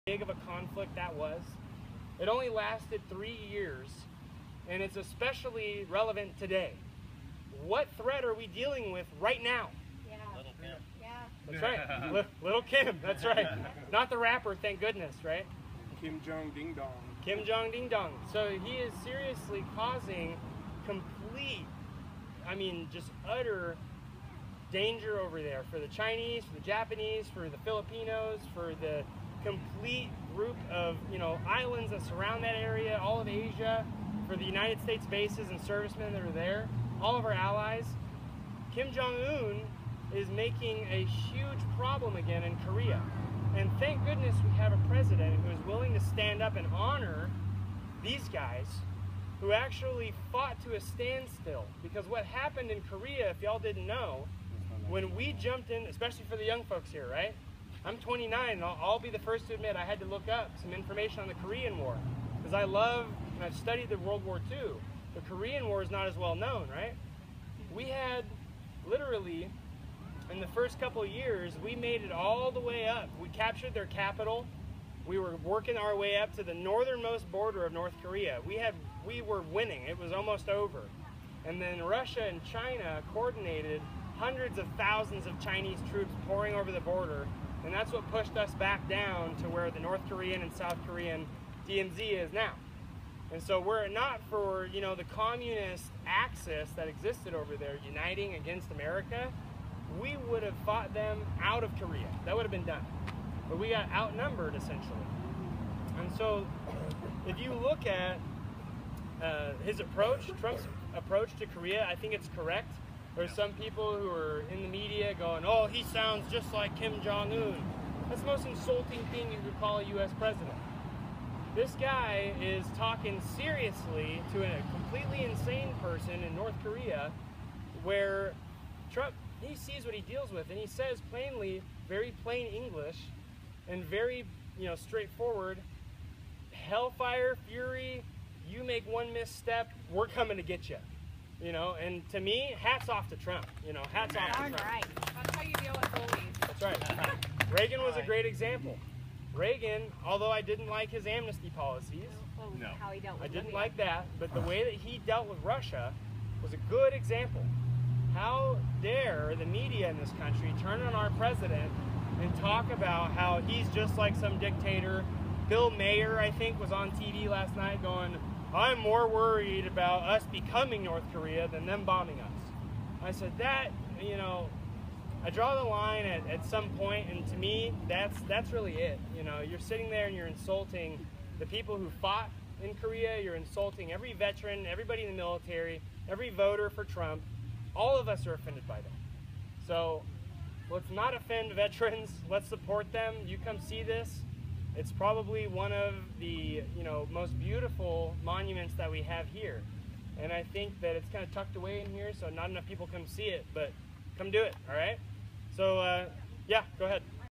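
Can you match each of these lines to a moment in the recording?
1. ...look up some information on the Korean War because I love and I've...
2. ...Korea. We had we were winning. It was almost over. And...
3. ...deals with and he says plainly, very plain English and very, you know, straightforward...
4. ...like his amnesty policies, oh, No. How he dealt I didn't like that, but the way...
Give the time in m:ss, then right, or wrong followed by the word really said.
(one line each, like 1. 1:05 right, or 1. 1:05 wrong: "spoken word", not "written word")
1. 1:00 right
2. 1:18 right
3. 2:10 right
4. 2:30 right.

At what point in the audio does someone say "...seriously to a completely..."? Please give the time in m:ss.
2:03.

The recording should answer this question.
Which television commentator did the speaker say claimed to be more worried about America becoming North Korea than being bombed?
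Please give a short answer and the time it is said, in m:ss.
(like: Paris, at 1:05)
Bill Maher, at 2:45.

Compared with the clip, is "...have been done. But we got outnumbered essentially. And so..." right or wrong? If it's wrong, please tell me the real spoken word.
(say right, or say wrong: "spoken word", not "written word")
right.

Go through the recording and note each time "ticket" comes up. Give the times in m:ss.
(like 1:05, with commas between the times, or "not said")
not said.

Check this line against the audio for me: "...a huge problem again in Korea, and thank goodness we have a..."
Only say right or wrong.
right.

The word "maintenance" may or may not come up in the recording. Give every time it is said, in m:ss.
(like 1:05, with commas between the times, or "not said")
not said.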